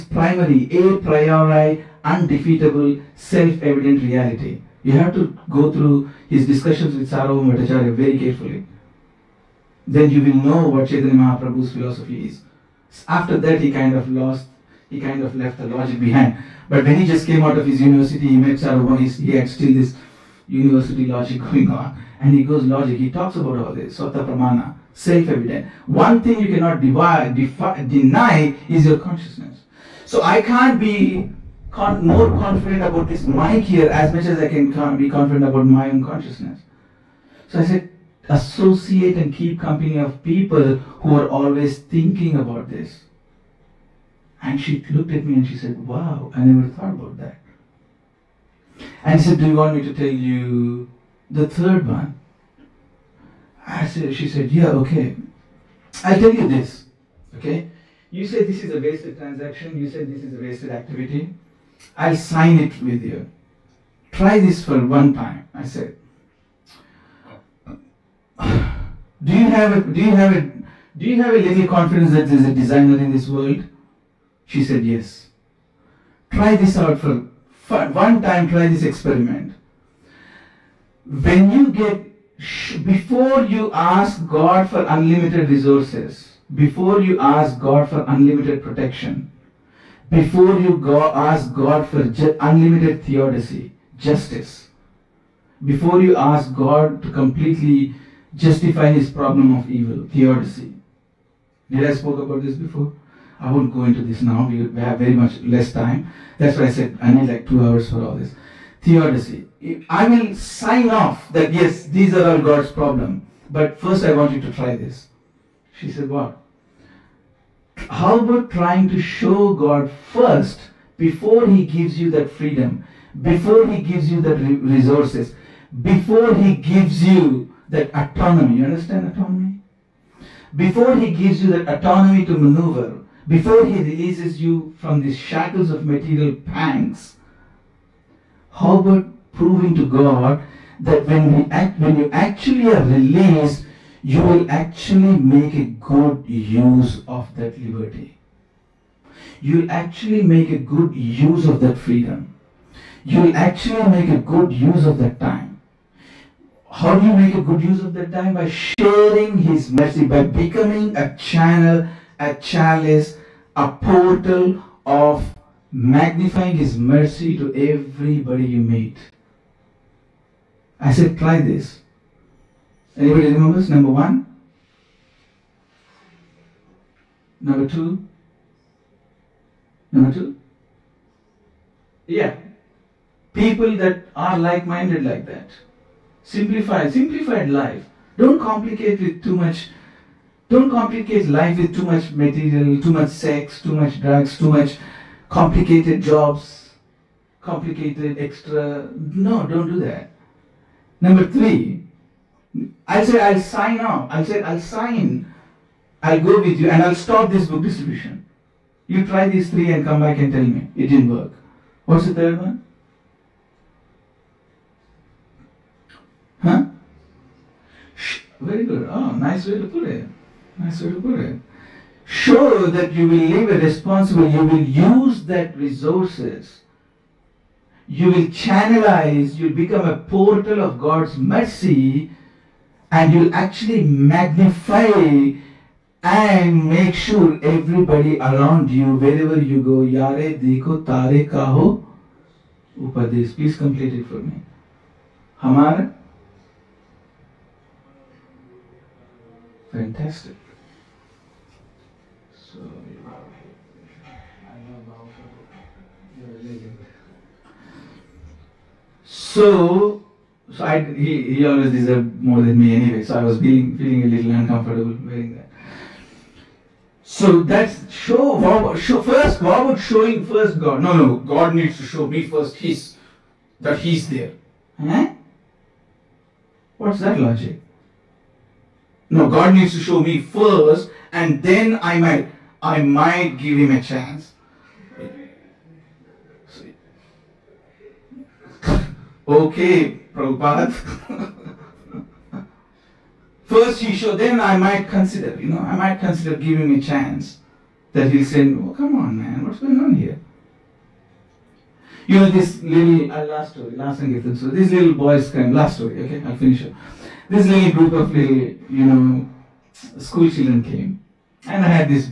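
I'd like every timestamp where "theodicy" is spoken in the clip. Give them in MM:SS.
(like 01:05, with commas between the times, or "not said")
01:33, 01:40, 01:48.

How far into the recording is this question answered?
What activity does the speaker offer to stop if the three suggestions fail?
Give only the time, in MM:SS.
03:27.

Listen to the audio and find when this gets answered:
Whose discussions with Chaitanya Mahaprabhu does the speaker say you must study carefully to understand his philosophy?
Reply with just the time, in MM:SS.
00:07.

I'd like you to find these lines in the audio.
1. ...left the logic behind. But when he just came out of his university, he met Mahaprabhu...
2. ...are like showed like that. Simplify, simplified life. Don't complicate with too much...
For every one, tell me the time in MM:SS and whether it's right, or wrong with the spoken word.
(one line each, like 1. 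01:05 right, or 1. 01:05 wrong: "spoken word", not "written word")
1. 00:15 wrong: "Sarvam", not "Mahaprabhu"
2. 03:04 wrong: "minded", not "showed".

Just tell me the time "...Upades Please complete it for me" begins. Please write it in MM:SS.
04:02.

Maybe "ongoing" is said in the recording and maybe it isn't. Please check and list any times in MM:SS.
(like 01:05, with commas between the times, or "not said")
not said.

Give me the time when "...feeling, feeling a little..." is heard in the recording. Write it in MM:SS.
04:23.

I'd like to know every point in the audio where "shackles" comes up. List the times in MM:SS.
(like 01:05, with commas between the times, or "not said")
02:15.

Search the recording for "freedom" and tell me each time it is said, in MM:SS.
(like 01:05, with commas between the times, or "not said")
02:02, 02:31.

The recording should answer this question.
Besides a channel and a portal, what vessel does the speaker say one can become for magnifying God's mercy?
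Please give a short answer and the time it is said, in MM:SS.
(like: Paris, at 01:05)
Chalice, at 02:42.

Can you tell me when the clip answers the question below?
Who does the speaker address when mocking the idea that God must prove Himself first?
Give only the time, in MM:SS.
04:50.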